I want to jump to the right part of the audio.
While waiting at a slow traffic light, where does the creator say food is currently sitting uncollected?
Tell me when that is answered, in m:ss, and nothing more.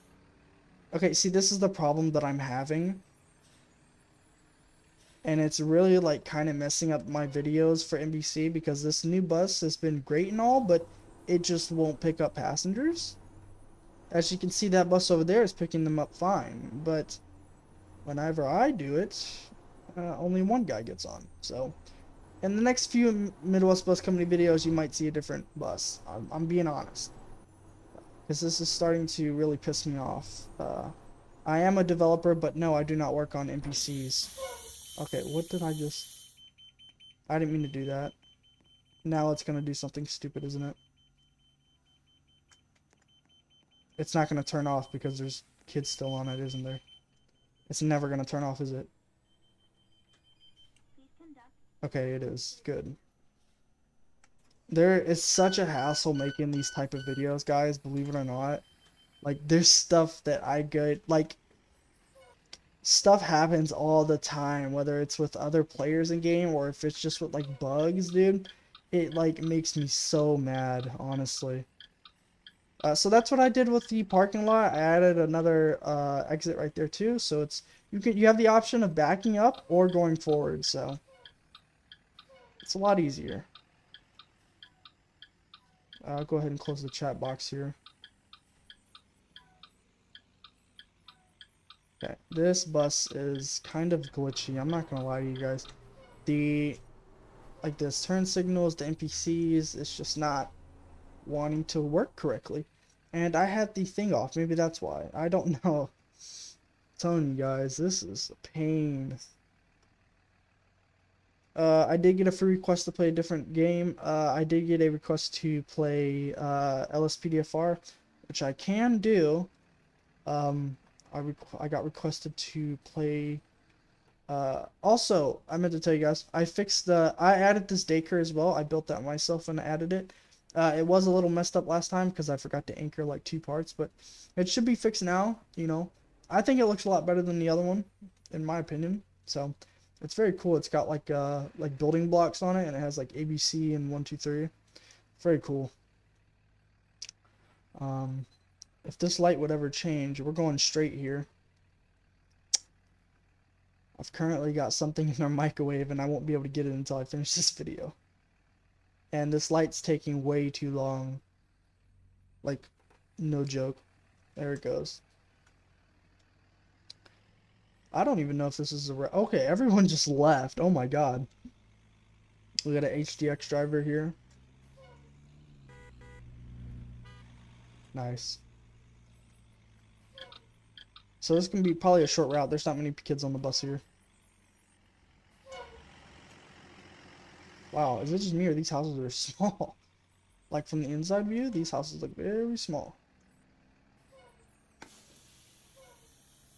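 2:35.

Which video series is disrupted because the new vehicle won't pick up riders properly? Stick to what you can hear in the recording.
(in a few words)
Midwest Bus Company.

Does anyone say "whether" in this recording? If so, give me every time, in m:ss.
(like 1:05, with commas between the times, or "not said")
1:04.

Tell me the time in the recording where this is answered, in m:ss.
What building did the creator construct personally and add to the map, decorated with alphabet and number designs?
2:07.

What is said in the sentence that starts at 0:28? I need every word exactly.
Because this is starting to really piss me off.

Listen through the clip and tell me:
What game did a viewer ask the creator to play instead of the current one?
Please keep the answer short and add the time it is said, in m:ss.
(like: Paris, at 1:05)
LSPDFR, at 1:56.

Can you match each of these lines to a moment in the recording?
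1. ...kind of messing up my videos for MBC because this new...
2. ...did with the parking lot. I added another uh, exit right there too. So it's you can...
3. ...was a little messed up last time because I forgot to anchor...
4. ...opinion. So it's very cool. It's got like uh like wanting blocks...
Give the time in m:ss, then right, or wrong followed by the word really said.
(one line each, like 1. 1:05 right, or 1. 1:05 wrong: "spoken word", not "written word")
1. 0:06 right
2. 1:13 right
3. 2:10 right
4. 2:18 wrong: "building", not "wanting".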